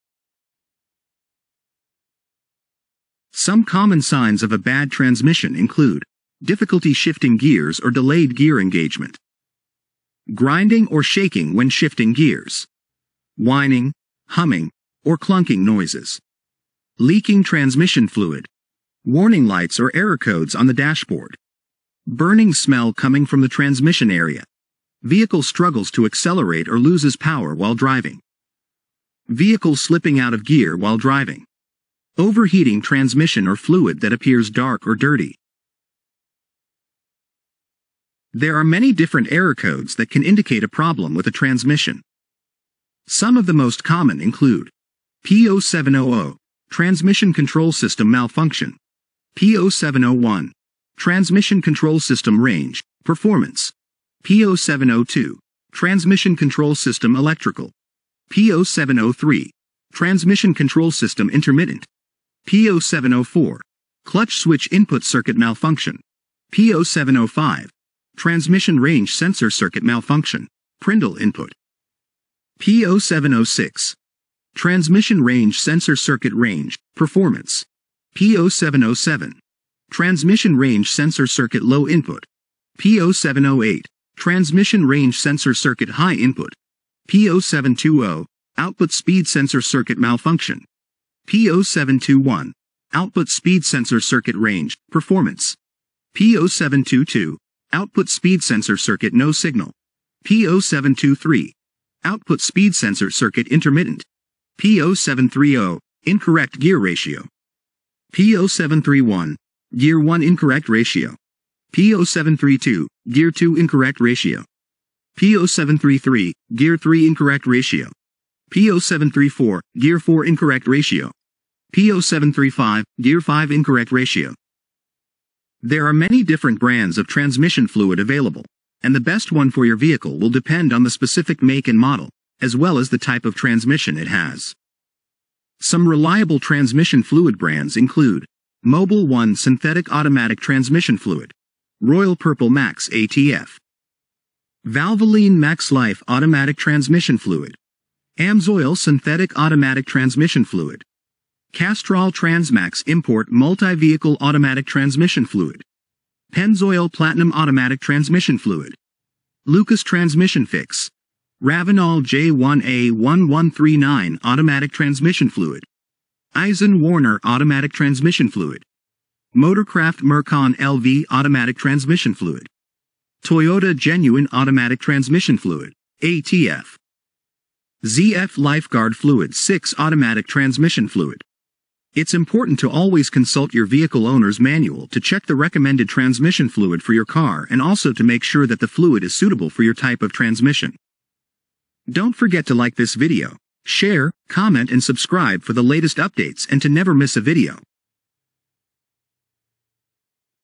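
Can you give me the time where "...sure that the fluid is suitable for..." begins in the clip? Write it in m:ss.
3:08.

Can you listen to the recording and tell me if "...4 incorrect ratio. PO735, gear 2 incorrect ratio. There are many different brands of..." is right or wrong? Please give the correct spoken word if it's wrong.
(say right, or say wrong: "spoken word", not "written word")
wrong: "5", not "2".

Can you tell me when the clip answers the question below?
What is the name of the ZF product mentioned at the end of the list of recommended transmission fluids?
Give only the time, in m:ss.
2:58.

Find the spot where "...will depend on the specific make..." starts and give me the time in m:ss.
2:10.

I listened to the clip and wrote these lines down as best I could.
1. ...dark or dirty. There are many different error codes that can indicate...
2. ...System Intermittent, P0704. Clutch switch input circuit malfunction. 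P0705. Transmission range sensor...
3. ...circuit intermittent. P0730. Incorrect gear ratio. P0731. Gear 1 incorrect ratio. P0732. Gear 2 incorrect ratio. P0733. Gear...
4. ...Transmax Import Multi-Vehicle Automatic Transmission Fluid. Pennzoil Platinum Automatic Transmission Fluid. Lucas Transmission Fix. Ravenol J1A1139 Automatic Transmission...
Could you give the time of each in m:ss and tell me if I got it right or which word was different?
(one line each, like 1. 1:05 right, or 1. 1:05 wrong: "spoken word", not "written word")
1. 0:34 right
2. 1:00 right
3. 1:43 right
4. 2:32 right.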